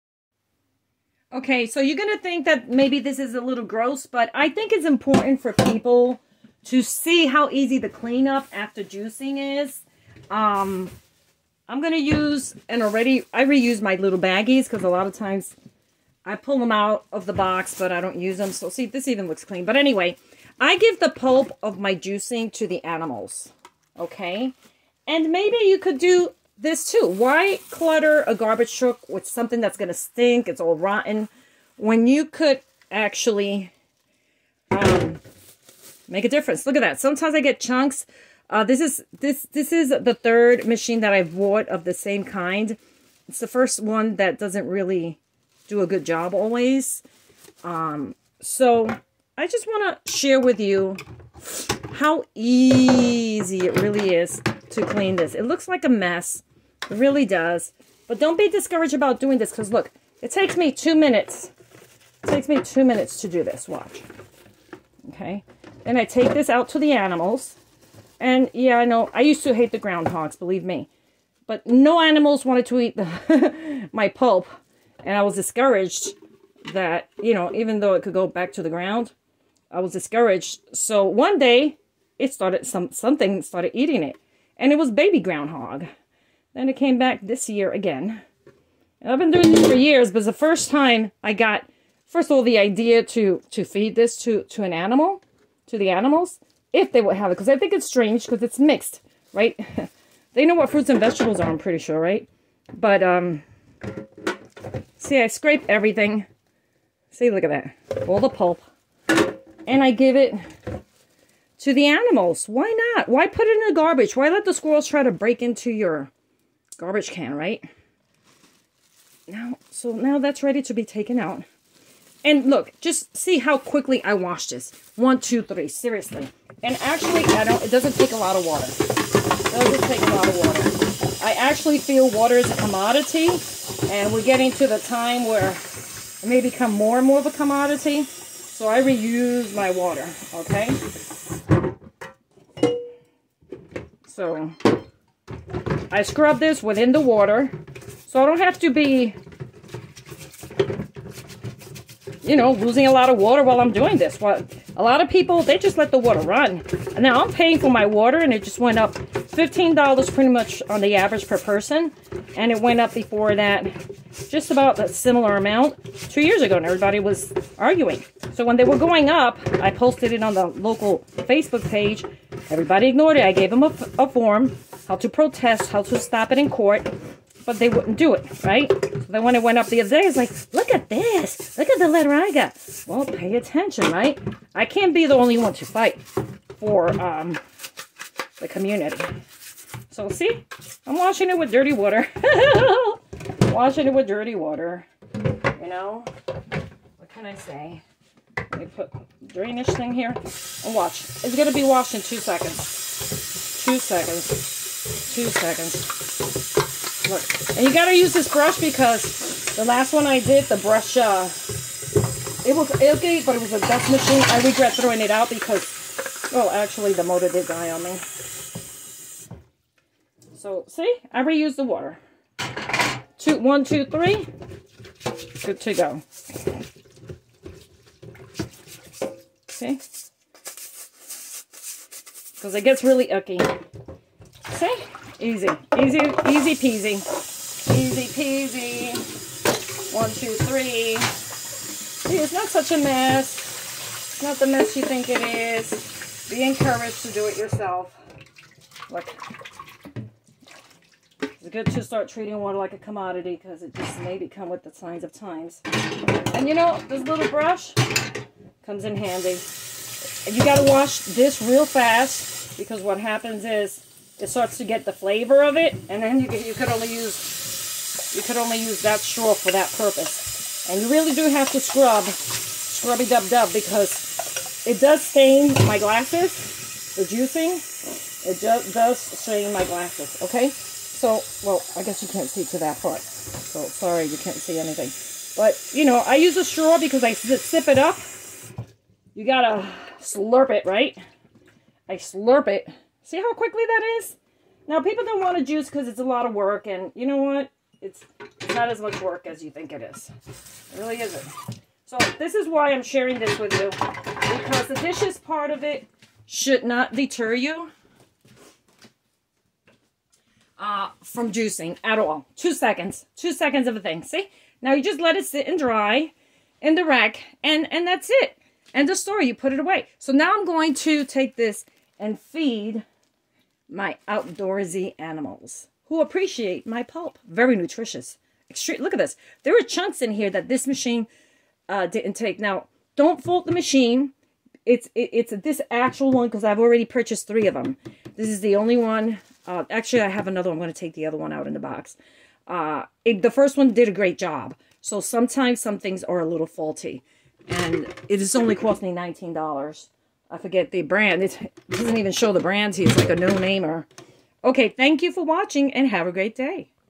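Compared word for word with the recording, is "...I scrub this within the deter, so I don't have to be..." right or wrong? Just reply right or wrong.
wrong.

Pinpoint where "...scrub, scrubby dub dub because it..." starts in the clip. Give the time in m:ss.
4:31.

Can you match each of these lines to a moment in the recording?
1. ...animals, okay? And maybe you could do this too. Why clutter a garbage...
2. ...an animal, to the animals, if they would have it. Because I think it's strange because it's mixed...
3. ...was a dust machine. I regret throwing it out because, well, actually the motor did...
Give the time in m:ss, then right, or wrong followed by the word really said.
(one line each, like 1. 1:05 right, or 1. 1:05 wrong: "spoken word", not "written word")
1. 0:22 right
2. 1:34 right
3. 3:33 right.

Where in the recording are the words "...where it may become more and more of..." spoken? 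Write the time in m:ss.
2:15.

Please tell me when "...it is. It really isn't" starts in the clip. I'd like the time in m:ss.
4:59.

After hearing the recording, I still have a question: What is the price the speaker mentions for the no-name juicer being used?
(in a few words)
$19.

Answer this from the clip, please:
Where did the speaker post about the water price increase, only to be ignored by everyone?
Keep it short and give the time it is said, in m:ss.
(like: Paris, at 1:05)
Local Facebook page, at 2:50.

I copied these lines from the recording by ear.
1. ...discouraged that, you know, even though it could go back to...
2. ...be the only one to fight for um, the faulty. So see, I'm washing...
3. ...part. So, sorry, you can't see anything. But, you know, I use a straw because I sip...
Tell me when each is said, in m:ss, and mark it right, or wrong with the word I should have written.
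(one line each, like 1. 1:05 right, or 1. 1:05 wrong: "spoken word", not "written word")
1. 1:15 right
2. 3:04 wrong: "community", not "faulty"
3. 4:42 right.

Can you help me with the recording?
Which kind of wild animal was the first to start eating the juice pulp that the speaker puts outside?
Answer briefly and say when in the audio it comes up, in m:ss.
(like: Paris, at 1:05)
Baby groundhog, at 1:24.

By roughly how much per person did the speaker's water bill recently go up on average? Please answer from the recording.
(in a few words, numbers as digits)
$15.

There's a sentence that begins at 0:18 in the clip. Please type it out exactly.
So see, this even looks clean.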